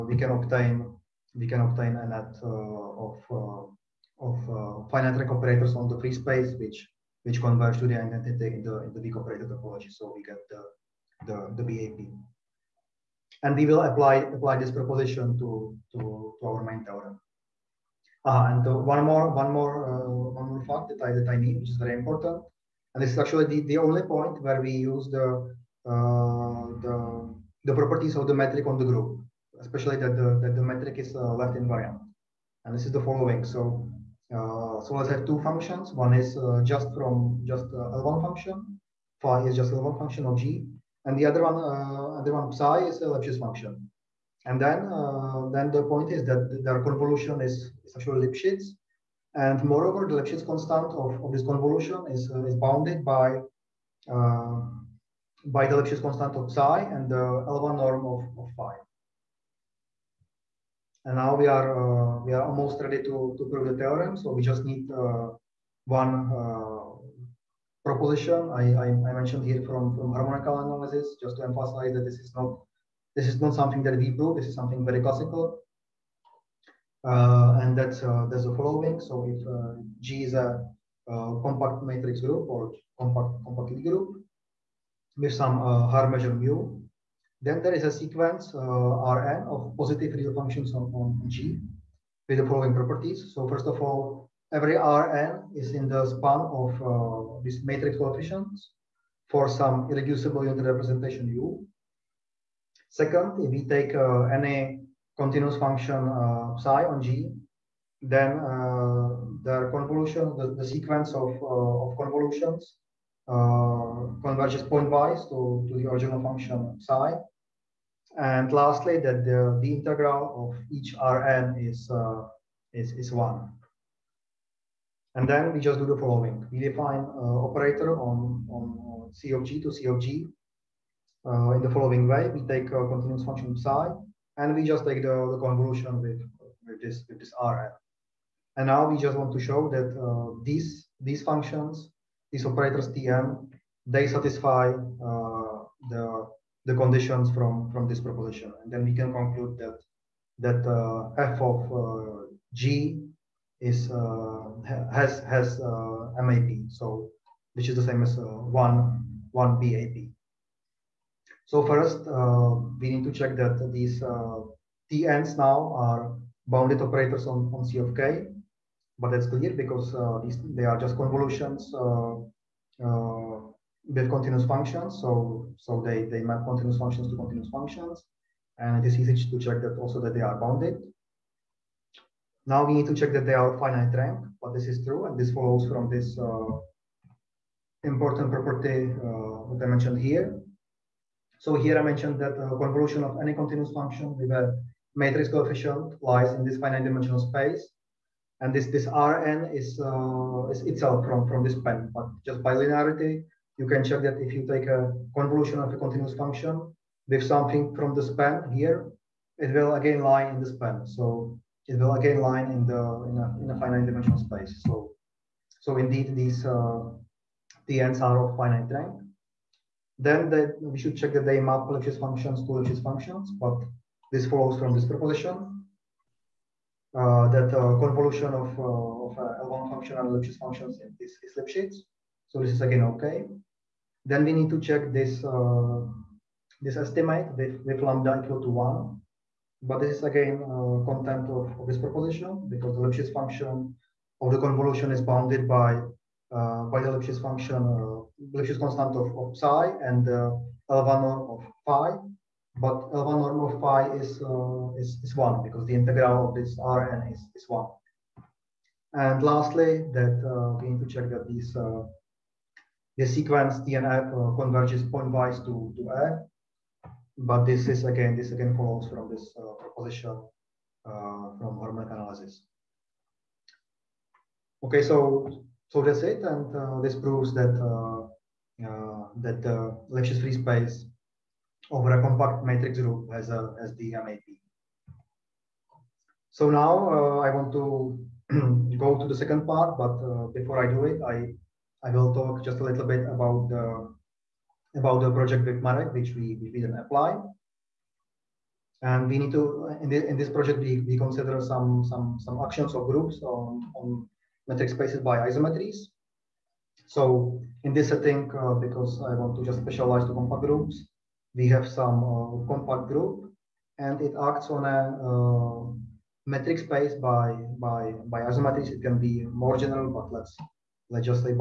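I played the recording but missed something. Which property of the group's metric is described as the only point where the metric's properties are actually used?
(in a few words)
Left invariant.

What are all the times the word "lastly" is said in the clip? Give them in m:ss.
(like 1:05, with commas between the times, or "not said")
1:58, 4:19.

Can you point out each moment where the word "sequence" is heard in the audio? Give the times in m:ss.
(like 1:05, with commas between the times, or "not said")
1:28, 1:50, 4:23.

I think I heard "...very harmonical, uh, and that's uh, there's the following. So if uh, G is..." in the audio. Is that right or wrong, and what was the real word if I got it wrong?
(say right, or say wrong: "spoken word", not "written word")
wrong: "classical", not "harmonical".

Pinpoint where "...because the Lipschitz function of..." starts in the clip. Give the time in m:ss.
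4:02.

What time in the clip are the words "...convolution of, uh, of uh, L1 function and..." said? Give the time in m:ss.
3:47.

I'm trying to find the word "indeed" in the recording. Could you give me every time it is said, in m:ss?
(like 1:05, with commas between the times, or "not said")
3:35.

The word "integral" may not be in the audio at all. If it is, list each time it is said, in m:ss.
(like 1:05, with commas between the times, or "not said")
1:59, 4:15.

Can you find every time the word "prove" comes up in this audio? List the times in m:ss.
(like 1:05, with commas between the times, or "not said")
1:03, 1:14, 4:36.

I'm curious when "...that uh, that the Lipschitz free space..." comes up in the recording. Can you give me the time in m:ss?
4:37.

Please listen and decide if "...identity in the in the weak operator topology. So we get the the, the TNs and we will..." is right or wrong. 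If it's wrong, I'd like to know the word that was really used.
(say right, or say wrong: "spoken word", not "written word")
wrong: "BAP", not "TNs".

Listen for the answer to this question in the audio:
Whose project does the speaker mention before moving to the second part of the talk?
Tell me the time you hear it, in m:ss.
4:55.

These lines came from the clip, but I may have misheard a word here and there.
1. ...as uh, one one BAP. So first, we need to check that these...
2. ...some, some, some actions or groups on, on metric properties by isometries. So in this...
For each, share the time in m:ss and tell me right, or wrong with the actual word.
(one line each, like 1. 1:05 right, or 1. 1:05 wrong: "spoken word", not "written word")
1. 2:38 right
2. 5:01 wrong: "spaces", not "properties".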